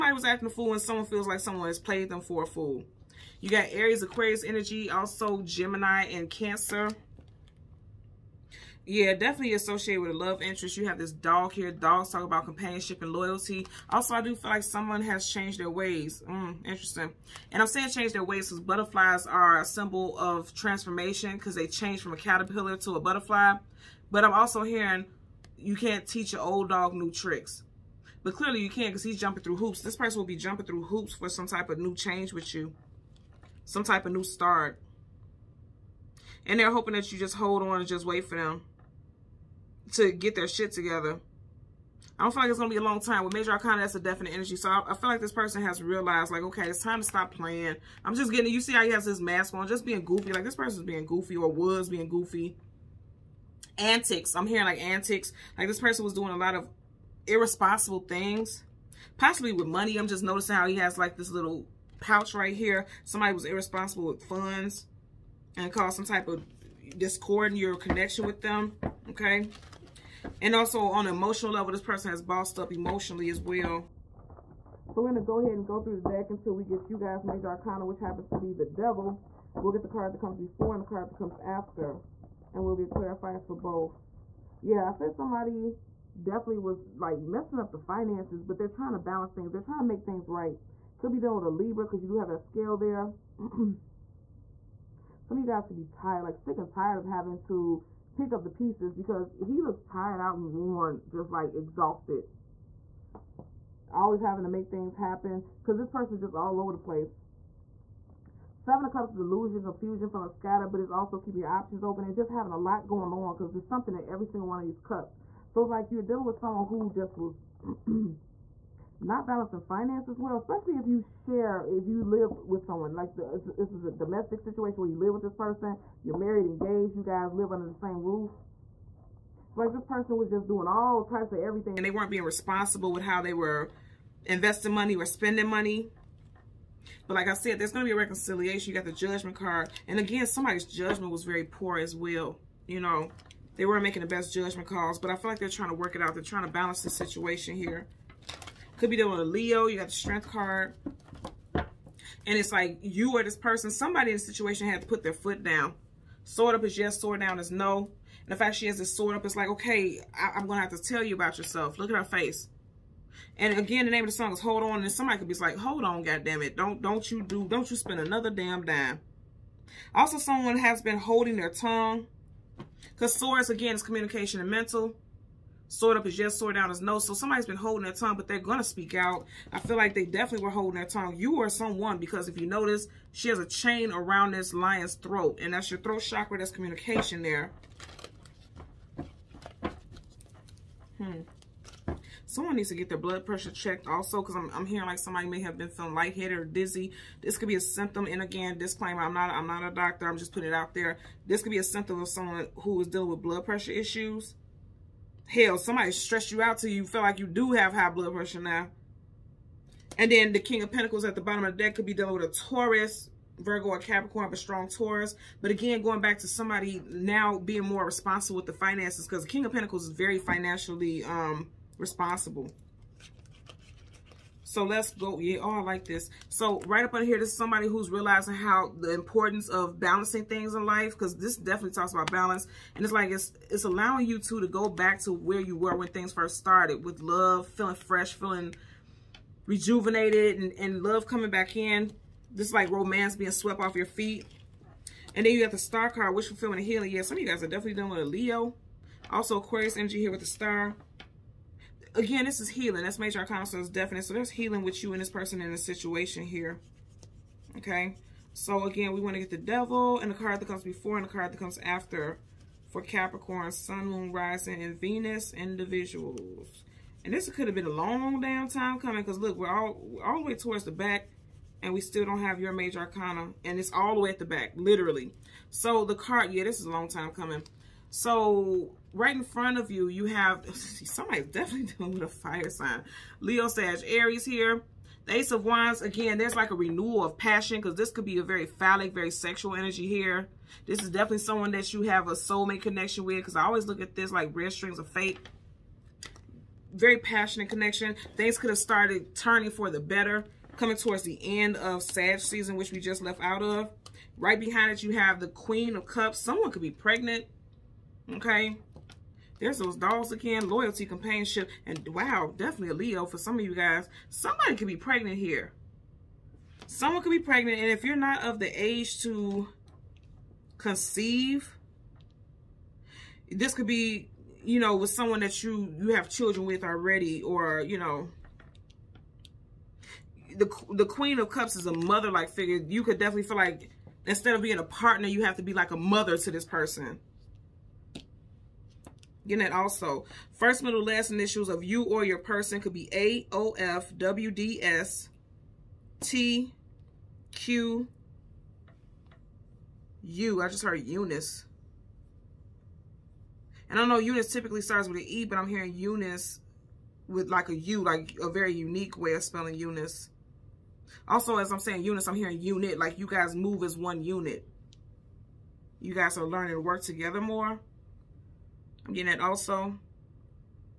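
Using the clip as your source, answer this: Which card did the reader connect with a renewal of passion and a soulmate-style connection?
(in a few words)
Ace of Wands.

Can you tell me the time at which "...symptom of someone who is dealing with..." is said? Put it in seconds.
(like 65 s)
201 s.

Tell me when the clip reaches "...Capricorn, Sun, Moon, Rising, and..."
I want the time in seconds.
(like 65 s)
262 s.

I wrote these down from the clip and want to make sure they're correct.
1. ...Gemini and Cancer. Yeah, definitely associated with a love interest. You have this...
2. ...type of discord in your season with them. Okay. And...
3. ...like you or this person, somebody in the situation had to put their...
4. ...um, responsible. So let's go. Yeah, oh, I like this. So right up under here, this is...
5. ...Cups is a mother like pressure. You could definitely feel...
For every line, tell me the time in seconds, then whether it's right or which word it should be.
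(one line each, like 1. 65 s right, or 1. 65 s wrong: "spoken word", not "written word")
1. 5 s right
2. 66 s wrong: "connection", not "season"
3. 152 s right
4. 221 s right
5. 331 s wrong: "figure", not "pressure".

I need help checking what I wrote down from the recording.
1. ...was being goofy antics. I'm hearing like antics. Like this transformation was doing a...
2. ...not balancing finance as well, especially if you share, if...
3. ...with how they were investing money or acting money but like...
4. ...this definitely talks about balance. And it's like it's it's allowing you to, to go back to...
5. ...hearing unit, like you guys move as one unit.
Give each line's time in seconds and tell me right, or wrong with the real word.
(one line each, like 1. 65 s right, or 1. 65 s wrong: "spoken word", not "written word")
1. 51 s wrong: "person", not "transformation"
2. 118 s right
3. 132 s wrong: "spending", not "acting"
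4. 231 s right
5. 362 s right.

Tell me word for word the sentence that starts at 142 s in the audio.
You know, they weren't making the best judgment calls.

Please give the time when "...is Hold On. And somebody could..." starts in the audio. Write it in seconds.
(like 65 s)
164 s.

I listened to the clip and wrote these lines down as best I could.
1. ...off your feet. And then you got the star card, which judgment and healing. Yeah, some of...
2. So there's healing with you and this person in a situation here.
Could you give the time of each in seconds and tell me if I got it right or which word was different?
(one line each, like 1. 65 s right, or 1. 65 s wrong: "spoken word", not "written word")
1. 243 s wrong: "fulfillment", not "judgment"
2. 254 s right.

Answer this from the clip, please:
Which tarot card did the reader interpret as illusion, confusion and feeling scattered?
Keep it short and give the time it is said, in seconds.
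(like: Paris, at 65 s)
Seven of Cups, at 108 s.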